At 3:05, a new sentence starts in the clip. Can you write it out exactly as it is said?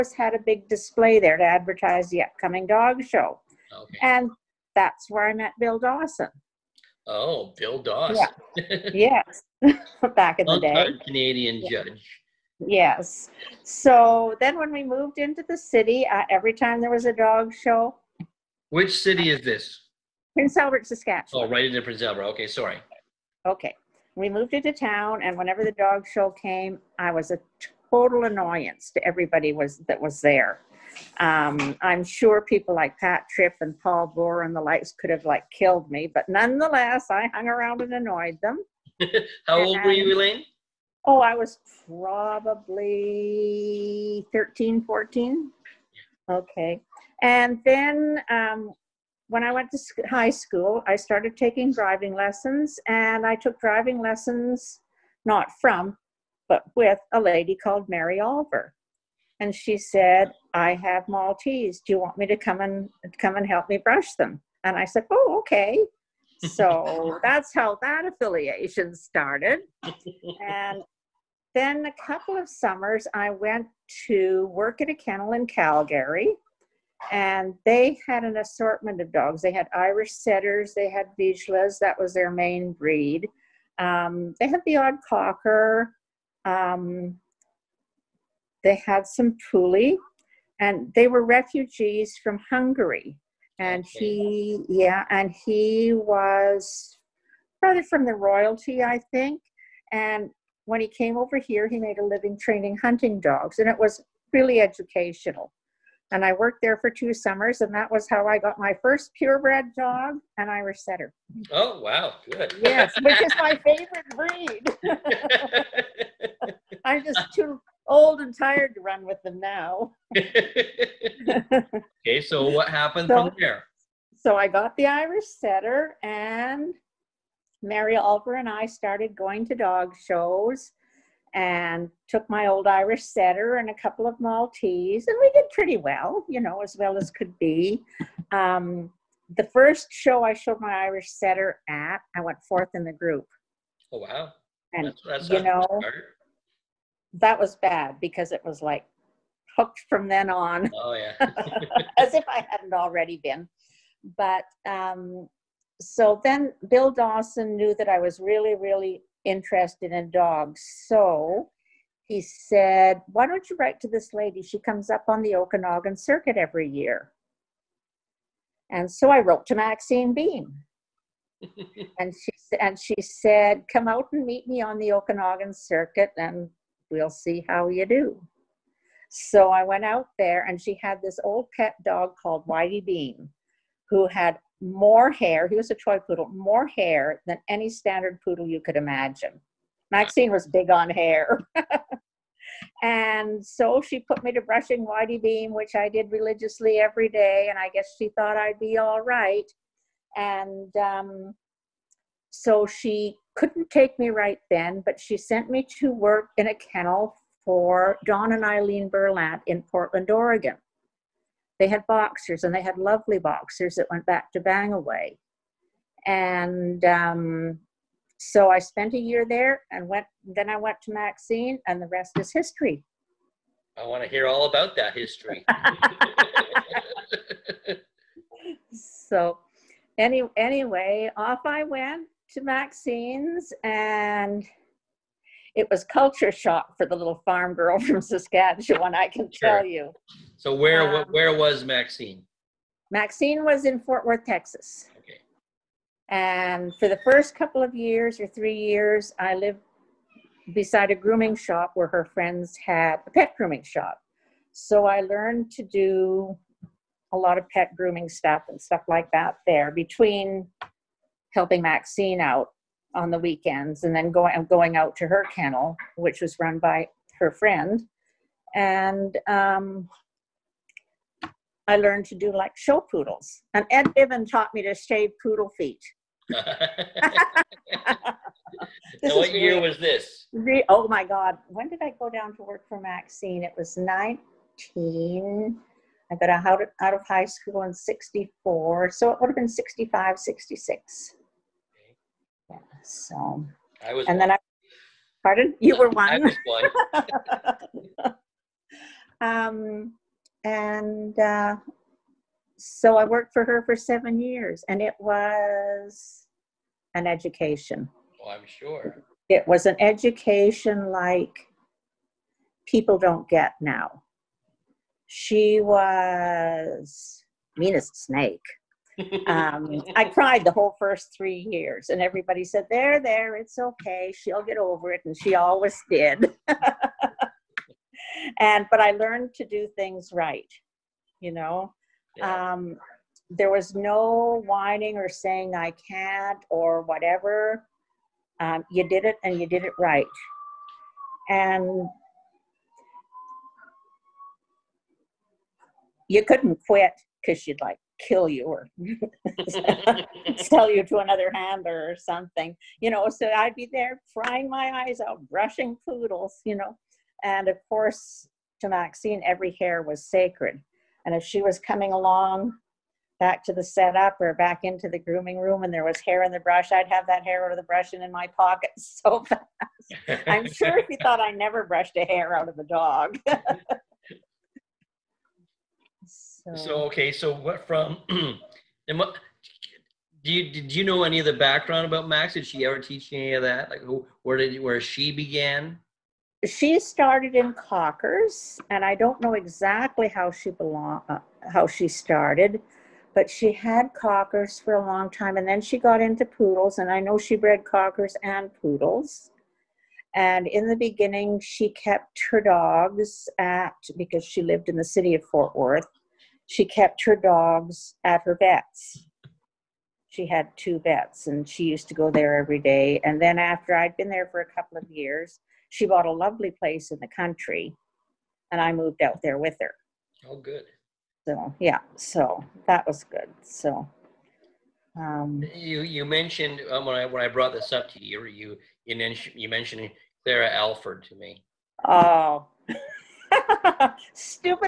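He was a toy poodle, more hair than any standard poodle you could imagine.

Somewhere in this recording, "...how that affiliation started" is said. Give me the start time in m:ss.
1:07.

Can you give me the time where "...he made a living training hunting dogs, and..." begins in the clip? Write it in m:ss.
1:41.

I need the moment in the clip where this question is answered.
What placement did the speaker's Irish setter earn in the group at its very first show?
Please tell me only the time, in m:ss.
2:22.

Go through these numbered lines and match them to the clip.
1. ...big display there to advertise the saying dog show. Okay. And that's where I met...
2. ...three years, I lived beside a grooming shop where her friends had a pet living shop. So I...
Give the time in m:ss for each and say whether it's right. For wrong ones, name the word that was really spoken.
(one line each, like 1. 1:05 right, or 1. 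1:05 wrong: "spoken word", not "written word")
1. 0:00 wrong: "upcoming", not "saying"
2. 4:08 wrong: "grooming", not "living".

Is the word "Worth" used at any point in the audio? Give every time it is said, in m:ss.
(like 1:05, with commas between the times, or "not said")
4:04, 6:45.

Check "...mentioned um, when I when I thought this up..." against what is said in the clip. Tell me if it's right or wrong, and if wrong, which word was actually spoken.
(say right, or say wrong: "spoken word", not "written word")
wrong: "brought", not "thought".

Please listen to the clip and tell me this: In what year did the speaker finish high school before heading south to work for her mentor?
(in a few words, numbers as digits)
1964.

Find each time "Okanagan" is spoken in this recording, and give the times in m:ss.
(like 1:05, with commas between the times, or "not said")
2:45, 2:54.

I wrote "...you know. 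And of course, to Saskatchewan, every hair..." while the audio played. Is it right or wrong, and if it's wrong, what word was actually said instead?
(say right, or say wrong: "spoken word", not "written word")
wrong: "Maxine", not "Saskatchewan".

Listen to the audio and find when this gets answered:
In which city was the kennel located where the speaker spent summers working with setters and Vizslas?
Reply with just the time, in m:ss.
1:15.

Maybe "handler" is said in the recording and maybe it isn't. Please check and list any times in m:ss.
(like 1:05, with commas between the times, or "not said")
5:51.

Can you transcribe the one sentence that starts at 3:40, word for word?
Then I went to Maxine, and the rest is history.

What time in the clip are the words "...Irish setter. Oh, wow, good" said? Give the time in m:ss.
1:50.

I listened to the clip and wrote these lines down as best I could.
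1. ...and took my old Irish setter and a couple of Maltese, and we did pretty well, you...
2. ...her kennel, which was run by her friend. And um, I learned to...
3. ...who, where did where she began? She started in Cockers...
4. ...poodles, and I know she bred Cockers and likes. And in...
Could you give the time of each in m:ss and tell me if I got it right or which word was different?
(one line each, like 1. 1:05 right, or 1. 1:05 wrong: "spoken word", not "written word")
1. 2:11 right
2. 4:25 right
3. 6:23 right
4. 6:36 wrong: "poodles", not "likes".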